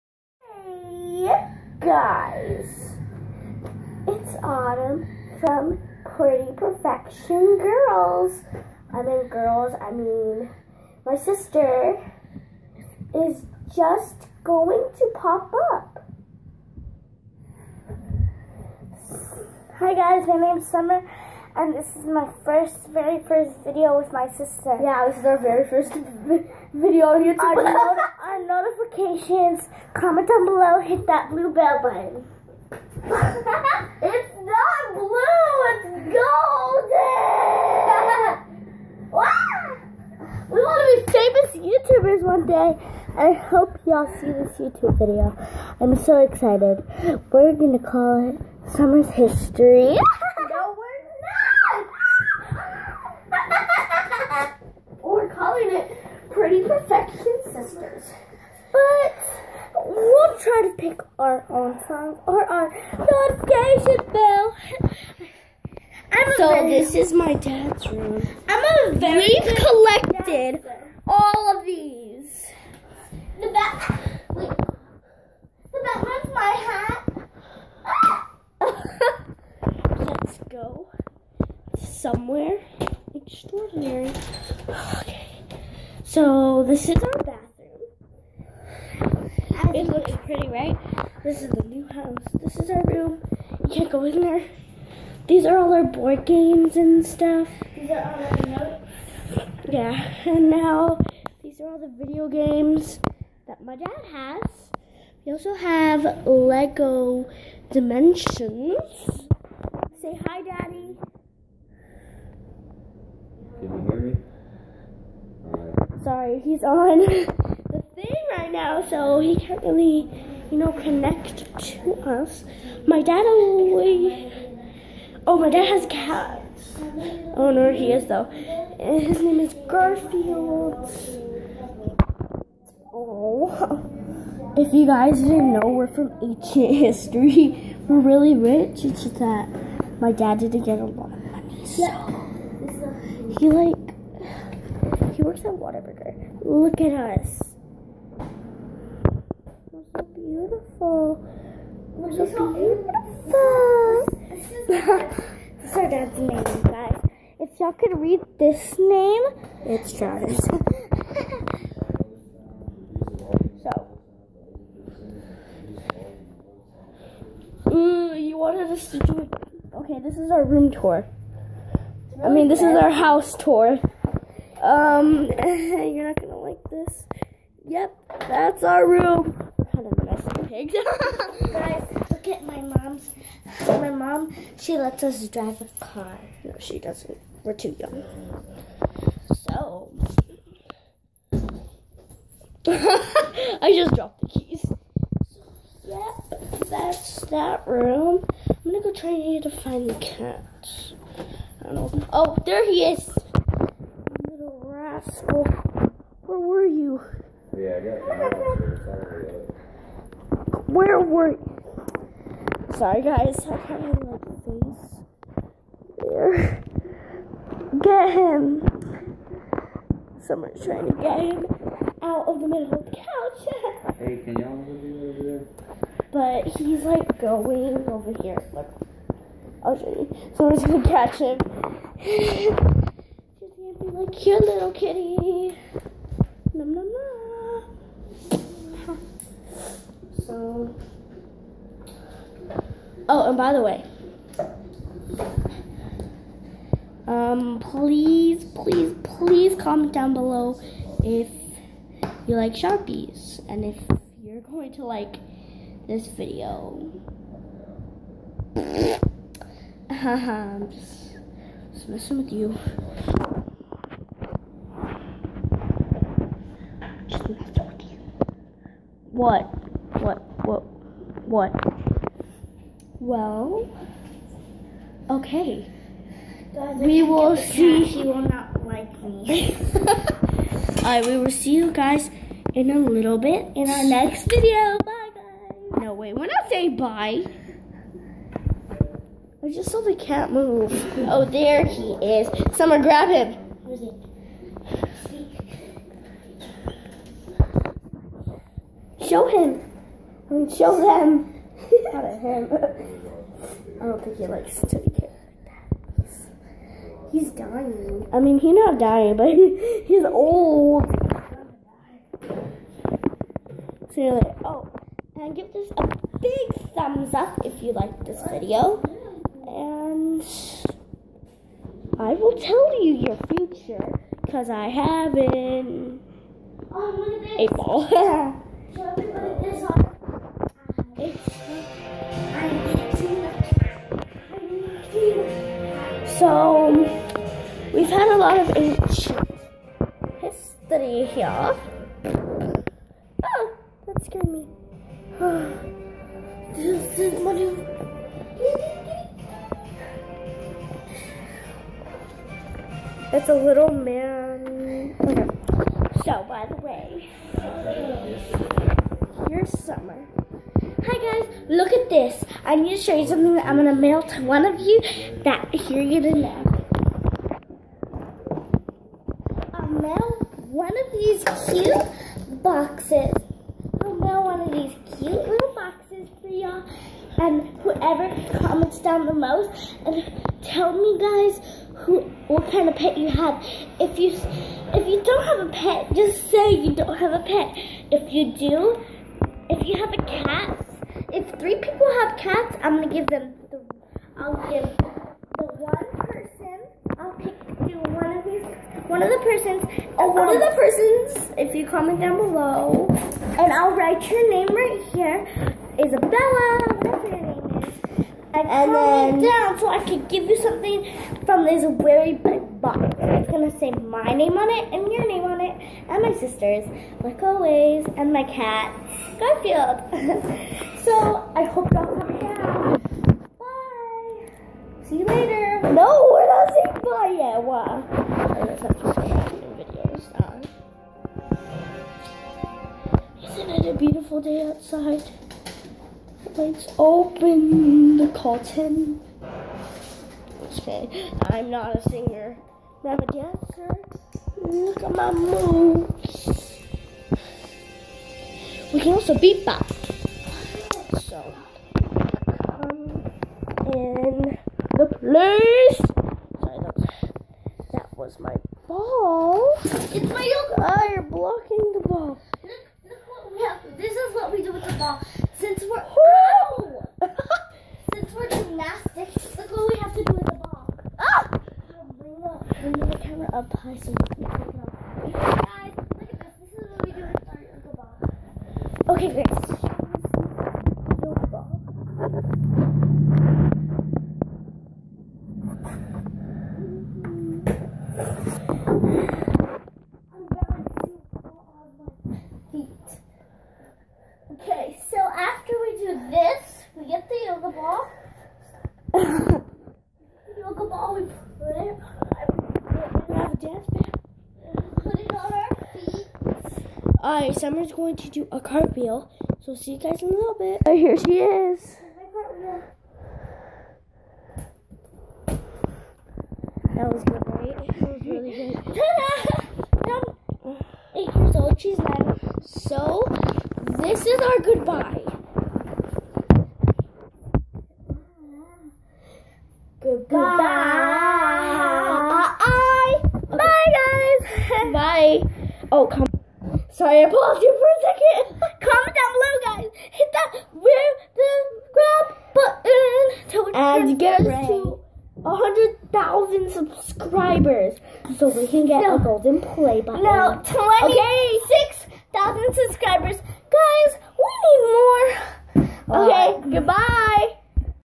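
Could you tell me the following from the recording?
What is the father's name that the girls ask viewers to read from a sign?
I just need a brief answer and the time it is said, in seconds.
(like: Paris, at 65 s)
Travis, at 159 s.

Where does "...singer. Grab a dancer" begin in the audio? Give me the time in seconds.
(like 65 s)
441 s.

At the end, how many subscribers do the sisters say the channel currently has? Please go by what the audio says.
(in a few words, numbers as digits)
26.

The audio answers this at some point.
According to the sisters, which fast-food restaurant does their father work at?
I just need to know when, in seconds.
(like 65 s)
145 s.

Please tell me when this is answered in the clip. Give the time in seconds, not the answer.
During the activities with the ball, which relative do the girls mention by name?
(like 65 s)
477 s.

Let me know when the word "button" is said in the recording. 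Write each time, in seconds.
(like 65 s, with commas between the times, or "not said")
31 s, 543 s, 549 s.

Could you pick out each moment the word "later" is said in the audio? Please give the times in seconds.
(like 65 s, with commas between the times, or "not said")
425 s.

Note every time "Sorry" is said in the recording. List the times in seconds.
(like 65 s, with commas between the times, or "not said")
116 s, 212 s, 456 s, 536 s.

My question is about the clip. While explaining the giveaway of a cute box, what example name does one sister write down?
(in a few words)
Isabella.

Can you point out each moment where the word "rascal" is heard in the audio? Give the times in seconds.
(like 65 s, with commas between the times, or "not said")
204 s.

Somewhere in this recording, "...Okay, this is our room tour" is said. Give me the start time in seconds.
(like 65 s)
169 s.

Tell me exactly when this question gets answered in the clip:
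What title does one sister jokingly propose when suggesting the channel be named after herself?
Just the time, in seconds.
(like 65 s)
48 s.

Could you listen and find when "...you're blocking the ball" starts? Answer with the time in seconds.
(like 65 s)
460 s.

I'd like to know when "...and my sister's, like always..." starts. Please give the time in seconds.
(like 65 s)
415 s.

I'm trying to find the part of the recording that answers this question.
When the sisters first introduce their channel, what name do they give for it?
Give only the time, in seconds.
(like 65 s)
6 s.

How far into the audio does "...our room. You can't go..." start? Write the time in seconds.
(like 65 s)
92 s.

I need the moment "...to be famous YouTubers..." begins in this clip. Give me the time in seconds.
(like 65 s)
40 s.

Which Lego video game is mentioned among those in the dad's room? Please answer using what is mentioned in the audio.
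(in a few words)
Lego Dimensions.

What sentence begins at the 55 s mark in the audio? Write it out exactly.
we're calling it Pretty Perfection Sisters.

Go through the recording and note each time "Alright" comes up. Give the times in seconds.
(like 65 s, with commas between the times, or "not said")
507 s.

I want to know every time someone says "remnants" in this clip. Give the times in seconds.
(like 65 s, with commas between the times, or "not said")
not said.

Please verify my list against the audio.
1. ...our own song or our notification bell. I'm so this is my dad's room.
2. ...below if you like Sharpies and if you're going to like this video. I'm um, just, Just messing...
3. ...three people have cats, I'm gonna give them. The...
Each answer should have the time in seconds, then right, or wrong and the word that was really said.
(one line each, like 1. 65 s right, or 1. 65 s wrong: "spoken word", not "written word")
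1. 61 s right
2. 250 s right
3. 391 s right.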